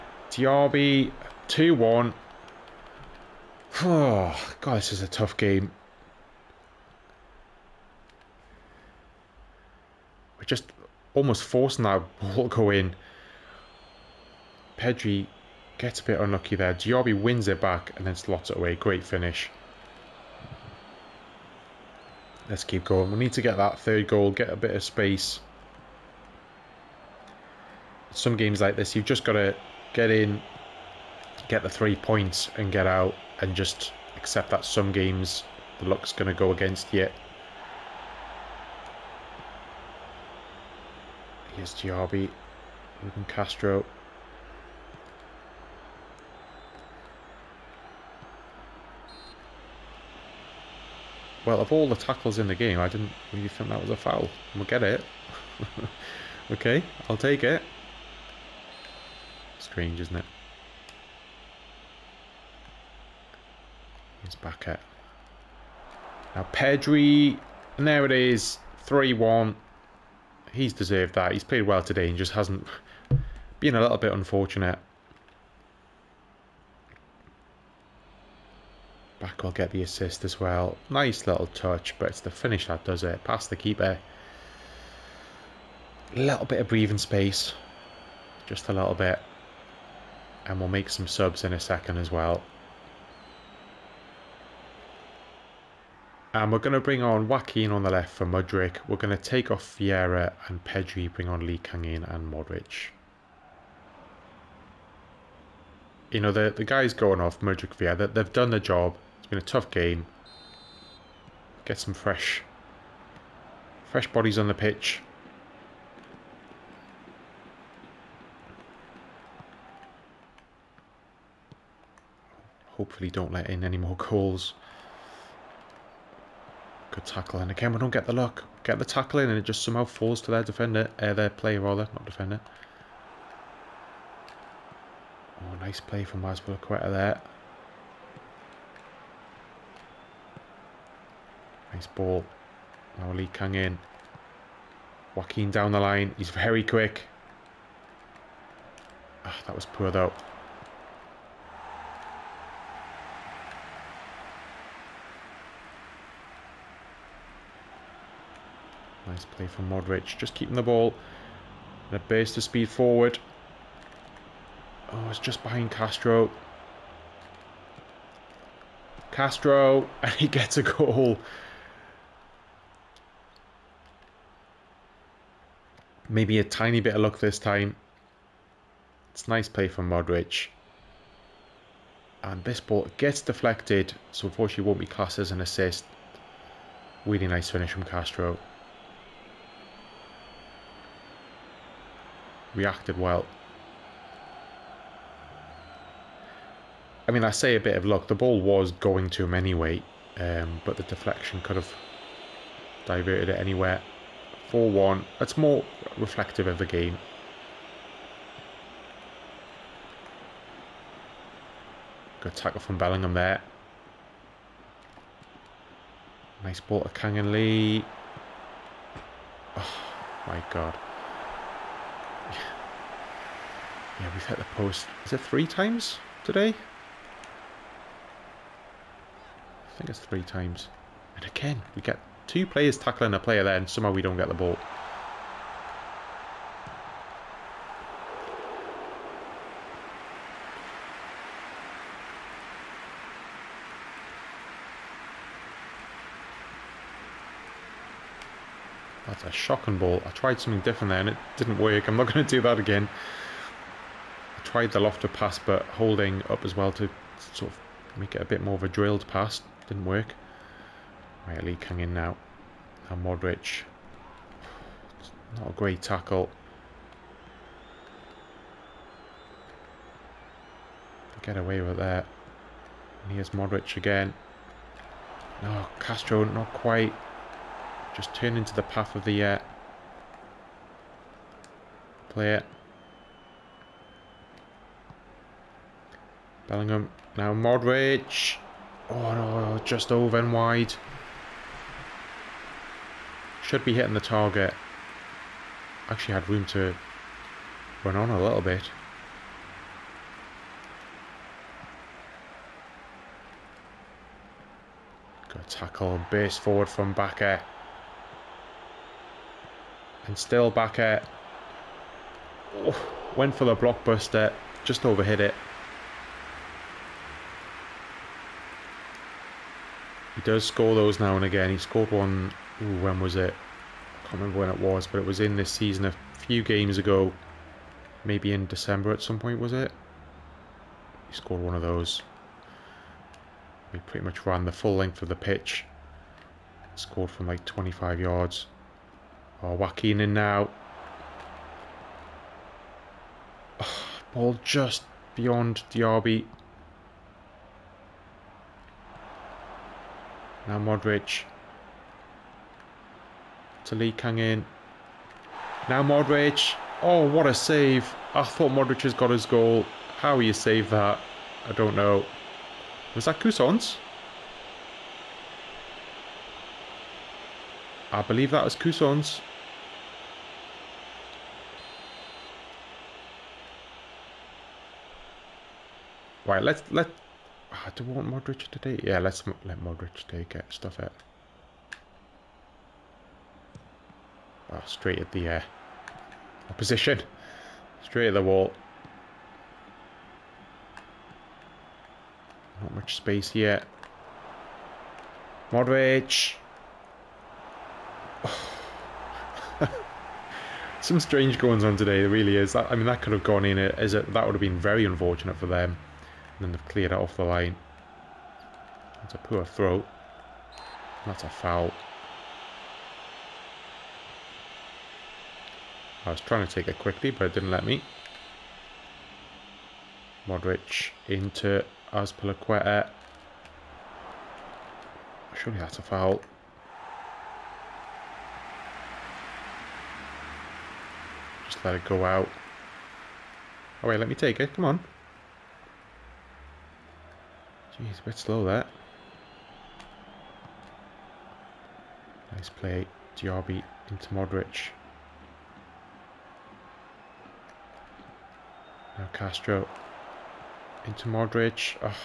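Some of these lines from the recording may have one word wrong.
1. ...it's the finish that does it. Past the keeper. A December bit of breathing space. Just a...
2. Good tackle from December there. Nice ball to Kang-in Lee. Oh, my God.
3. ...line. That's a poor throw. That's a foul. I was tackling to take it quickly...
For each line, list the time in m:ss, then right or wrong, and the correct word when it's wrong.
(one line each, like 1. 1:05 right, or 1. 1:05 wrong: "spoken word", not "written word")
1. 1:22 wrong: "Little", not "December"
2. 3:32 wrong: "Bellingham", not "December"
3. 6:47 wrong: "trying", not "tackling".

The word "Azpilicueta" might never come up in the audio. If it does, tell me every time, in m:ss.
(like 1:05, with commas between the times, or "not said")
2:16, 7:01.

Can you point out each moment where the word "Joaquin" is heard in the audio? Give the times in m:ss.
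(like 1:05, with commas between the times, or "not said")
1:37, 2:25, 5:39.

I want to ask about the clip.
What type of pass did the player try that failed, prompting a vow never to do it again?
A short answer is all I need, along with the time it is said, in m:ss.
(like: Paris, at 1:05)
Lofted pass, at 4:14.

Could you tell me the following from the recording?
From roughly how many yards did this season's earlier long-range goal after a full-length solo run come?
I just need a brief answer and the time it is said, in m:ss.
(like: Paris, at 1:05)
25, at 5:36.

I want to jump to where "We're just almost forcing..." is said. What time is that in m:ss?
0:10.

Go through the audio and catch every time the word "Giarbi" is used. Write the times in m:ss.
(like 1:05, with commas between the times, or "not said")
0:41.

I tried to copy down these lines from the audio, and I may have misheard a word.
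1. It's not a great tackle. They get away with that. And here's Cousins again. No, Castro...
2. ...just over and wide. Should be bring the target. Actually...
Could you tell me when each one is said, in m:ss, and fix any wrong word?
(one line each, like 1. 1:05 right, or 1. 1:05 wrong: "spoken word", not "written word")
1. 4:24 wrong: "Modric", not "Cousins"
2. 4:49 wrong: "hitting", not "bring".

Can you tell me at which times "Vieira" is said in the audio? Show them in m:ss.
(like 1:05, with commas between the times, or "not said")
1:39, 1:47.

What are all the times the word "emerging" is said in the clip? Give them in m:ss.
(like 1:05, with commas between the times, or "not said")
not said.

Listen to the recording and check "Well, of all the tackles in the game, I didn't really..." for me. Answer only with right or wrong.
right.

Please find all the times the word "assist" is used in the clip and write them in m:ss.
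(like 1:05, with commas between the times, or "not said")
1:19, 3:05.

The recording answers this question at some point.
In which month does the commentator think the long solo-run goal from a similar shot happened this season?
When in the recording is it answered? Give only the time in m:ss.
5:28.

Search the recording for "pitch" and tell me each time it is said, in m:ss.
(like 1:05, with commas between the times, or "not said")
1:54, 5:35.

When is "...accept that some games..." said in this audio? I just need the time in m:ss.
0:34.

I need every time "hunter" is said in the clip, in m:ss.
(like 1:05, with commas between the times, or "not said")
not said.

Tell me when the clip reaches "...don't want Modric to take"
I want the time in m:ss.
6:17.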